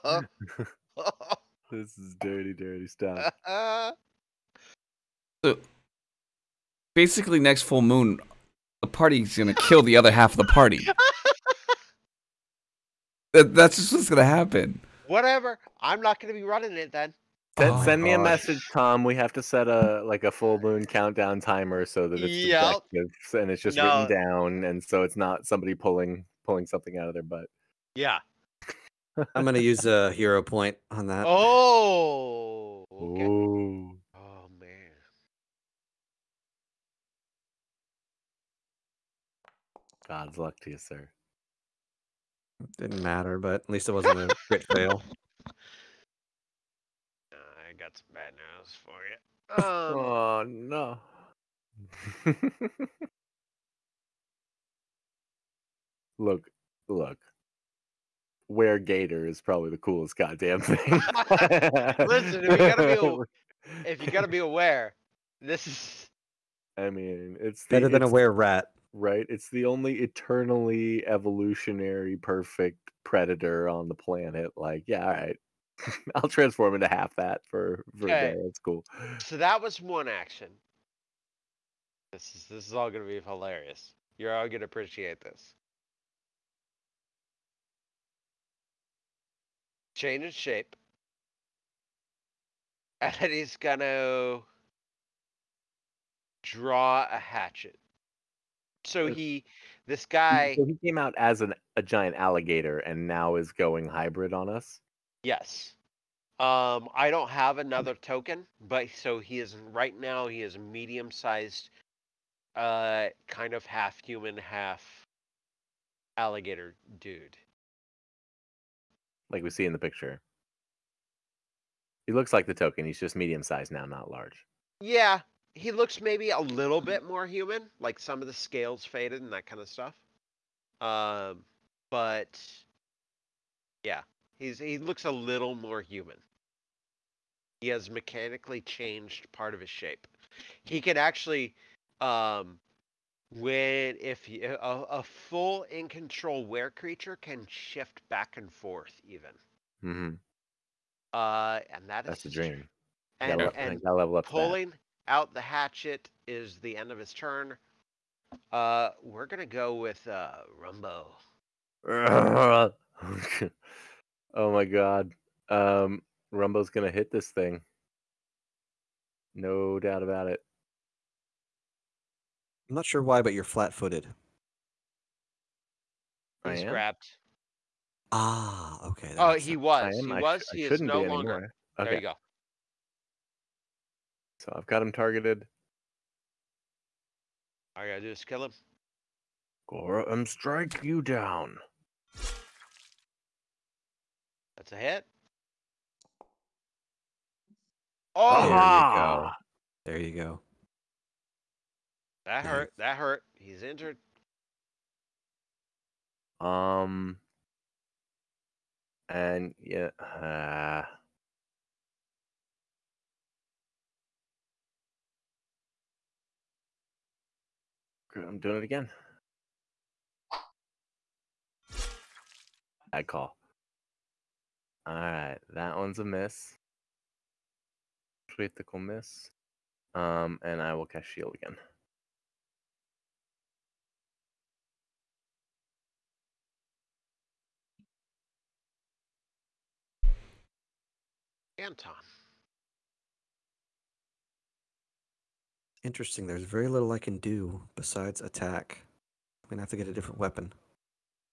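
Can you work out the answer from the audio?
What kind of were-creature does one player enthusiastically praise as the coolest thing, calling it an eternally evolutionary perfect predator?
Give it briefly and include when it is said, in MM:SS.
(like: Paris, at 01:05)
Were gator, at 00:58.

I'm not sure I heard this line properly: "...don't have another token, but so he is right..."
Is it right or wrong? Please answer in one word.
right.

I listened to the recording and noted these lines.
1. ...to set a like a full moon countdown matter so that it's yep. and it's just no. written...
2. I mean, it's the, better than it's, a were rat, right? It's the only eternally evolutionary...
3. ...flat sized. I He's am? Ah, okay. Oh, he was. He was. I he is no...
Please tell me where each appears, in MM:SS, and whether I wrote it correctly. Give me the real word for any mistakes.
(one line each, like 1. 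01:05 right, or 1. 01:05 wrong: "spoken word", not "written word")
1. 00:19 wrong: "timer", not "matter"
2. 01:06 right
3. 02:53 wrong: "footed", not "sized".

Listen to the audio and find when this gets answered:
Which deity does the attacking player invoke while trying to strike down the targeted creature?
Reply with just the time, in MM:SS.
03:09.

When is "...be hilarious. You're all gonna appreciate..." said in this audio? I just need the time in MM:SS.
01:23.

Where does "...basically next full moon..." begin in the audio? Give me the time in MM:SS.
00:06.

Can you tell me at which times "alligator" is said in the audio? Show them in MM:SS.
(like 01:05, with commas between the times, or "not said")
01:42, 01:56.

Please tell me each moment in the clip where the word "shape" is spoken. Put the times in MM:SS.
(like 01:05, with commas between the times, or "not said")
01:30, 02:19.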